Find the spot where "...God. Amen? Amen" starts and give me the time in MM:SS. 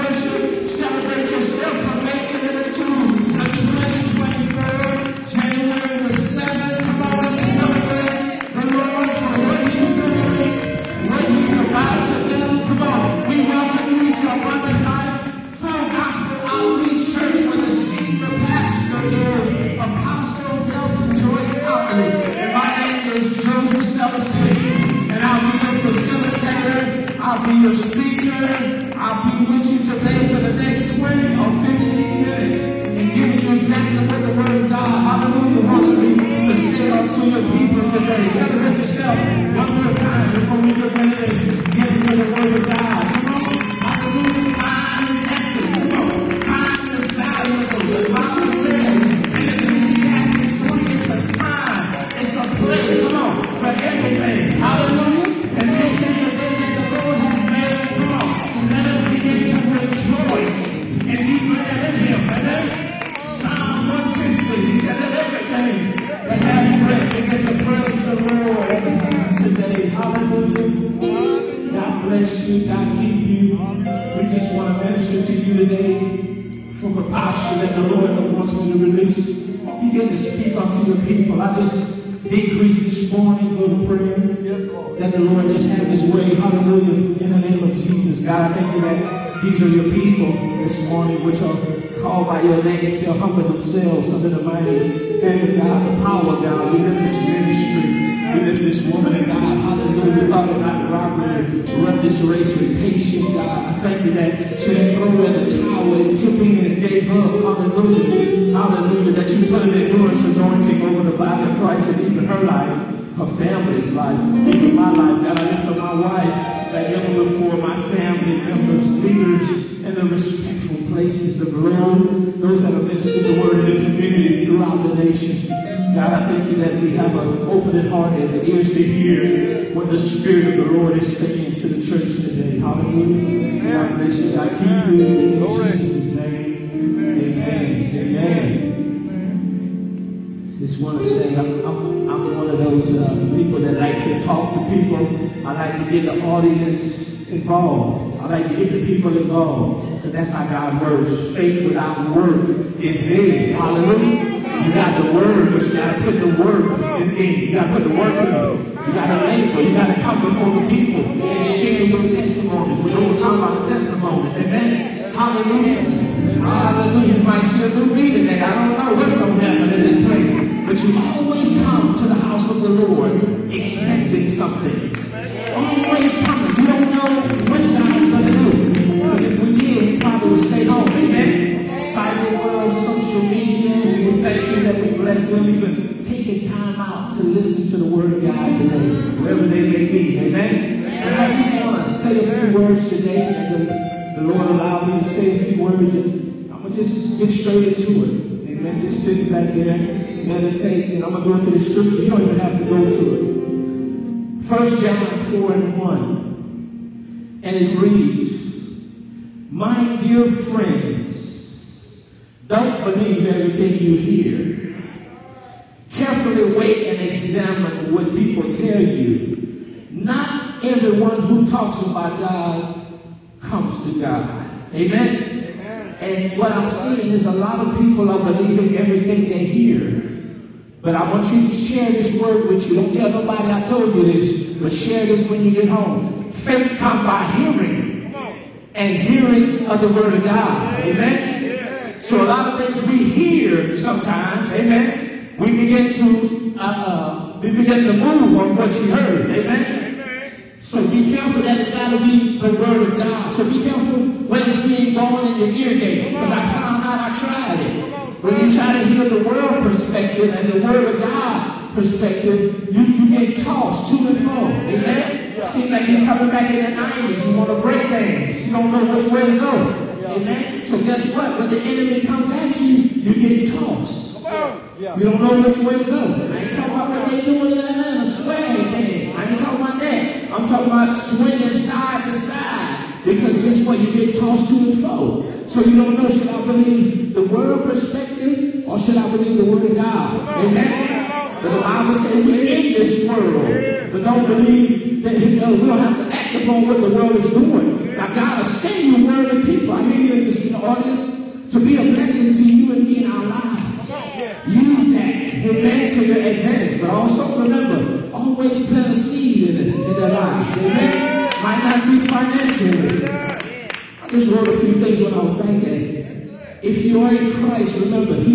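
03:43.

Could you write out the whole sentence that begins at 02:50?
But you always come to the house of the Lord expecting something.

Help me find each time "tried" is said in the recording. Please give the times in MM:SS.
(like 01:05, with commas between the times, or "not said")
04:17.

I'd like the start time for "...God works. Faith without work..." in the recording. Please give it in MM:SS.
02:30.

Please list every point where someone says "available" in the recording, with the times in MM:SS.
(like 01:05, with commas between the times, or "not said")
not said.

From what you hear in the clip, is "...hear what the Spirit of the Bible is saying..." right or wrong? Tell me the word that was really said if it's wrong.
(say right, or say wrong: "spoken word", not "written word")
wrong: "Lord", not "Bible".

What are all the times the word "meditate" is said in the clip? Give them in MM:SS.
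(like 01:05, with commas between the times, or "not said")
03:20.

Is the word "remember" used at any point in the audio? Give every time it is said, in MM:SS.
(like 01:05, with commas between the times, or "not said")
05:07, 05:17.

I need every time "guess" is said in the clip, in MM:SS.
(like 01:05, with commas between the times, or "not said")
04:30, 04:43.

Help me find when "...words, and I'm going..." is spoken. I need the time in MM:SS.
03:15.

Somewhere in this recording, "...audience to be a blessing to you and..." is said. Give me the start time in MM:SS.
05:00.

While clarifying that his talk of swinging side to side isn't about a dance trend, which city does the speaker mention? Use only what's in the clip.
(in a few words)
Atlanta.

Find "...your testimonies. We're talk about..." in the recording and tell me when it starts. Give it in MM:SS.
02:41.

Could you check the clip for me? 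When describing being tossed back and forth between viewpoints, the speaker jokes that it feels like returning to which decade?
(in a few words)
the 90s.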